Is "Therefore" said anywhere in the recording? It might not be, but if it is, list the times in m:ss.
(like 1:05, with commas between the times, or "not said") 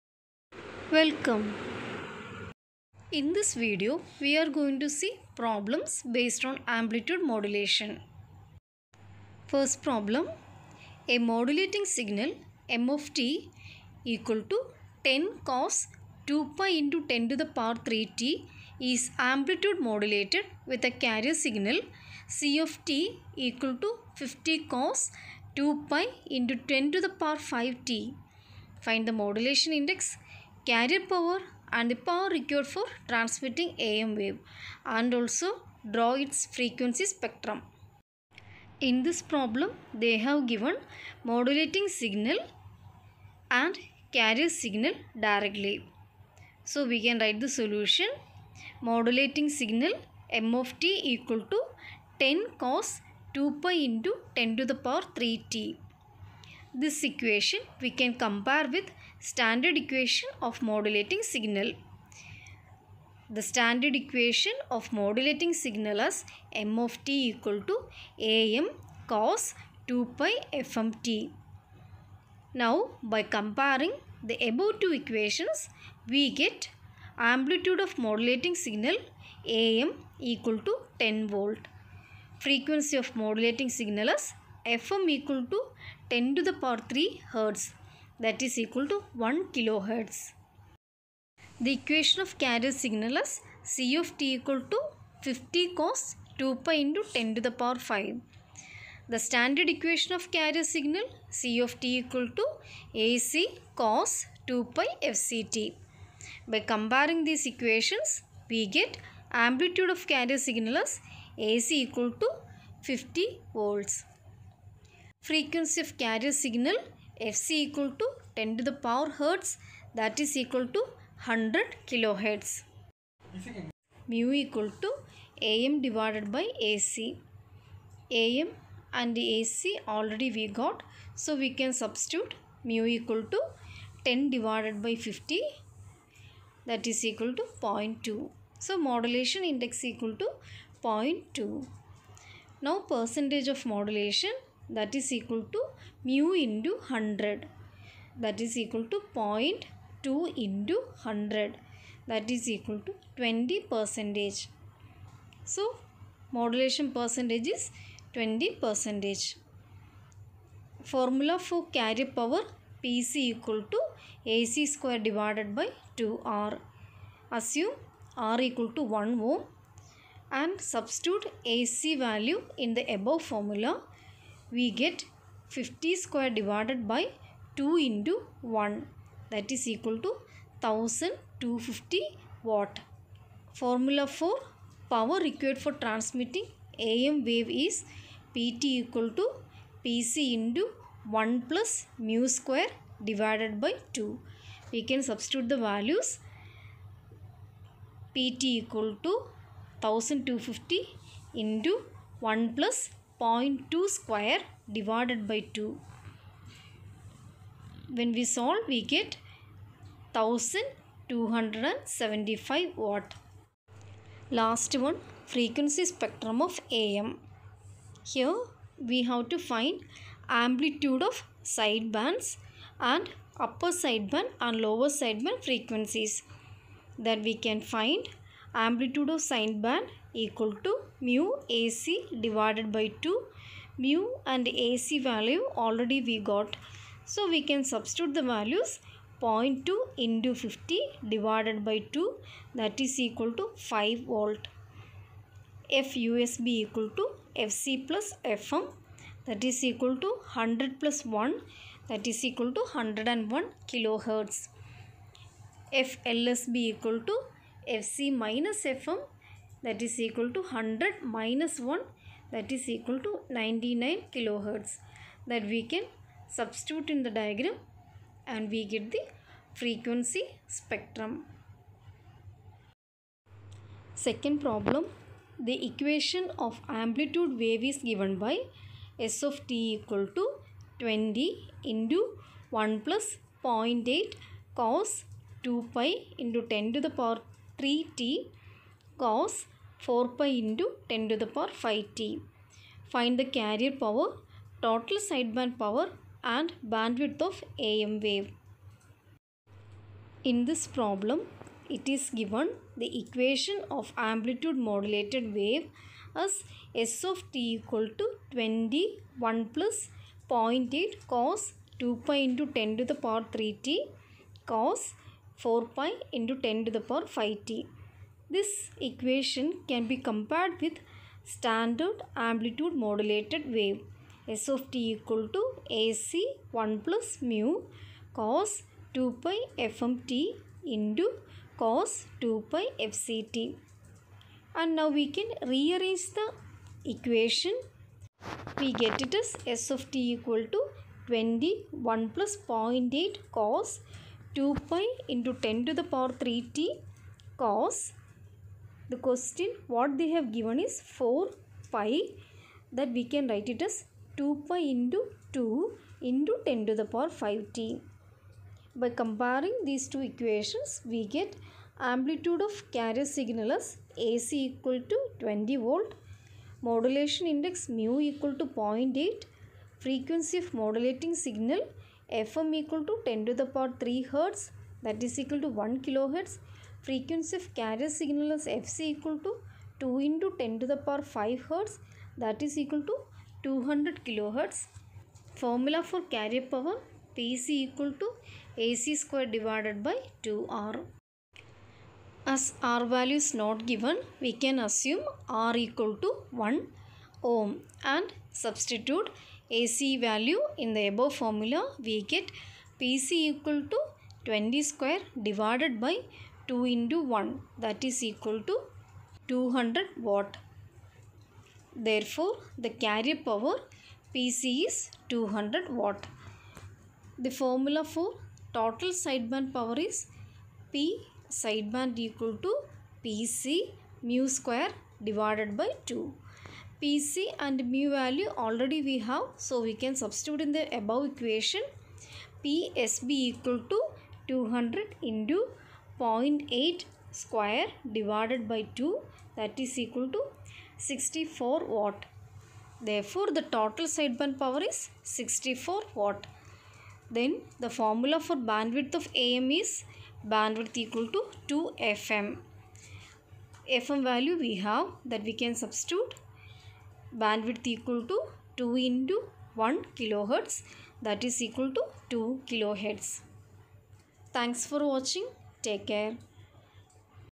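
6:51, 7:22.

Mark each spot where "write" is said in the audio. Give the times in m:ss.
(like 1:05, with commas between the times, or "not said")
0:47, 5:53.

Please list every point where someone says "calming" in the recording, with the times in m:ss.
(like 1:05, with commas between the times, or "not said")
not said.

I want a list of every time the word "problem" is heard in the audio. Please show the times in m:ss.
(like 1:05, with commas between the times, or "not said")
0:05, 0:09, 0:39, 4:34, 5:00.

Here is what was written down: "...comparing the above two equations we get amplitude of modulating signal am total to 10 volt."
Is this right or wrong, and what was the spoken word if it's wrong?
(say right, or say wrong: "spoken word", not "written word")
wrong: "equal", not "total".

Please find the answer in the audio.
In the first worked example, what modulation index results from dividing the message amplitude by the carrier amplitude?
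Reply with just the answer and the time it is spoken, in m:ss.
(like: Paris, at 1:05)
0.2, at 2:16.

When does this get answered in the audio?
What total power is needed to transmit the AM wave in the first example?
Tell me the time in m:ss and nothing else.
3:30.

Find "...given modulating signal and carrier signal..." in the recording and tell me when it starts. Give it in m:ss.
0:40.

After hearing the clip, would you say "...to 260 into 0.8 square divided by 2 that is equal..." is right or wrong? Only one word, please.
wrong.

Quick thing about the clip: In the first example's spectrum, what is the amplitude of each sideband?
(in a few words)
5 volt.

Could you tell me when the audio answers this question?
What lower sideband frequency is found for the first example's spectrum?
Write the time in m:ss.
4:23.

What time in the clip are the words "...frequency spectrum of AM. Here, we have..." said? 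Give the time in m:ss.
3:35.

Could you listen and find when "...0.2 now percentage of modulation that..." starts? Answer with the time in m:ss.
2:20.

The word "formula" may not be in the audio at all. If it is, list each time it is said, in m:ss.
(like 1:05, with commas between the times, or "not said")
2:40, 2:53, 3:03, 6:25, 6:41, 6:57, 7:27.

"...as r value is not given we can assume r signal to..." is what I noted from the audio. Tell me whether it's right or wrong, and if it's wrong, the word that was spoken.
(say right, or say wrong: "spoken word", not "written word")
wrong: "equal", not "signal".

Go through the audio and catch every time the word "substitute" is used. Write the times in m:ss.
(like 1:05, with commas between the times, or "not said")
2:11, 2:50, 3:15, 3:57, 4:26, 6:38, 7:09, 7:35.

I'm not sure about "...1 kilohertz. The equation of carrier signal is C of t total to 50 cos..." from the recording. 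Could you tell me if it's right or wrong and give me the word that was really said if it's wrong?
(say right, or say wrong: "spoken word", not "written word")
wrong: "equal", not "total".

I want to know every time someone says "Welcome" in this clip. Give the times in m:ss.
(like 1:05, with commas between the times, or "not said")
0:00.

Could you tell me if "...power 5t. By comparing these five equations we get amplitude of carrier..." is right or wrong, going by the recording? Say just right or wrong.
wrong.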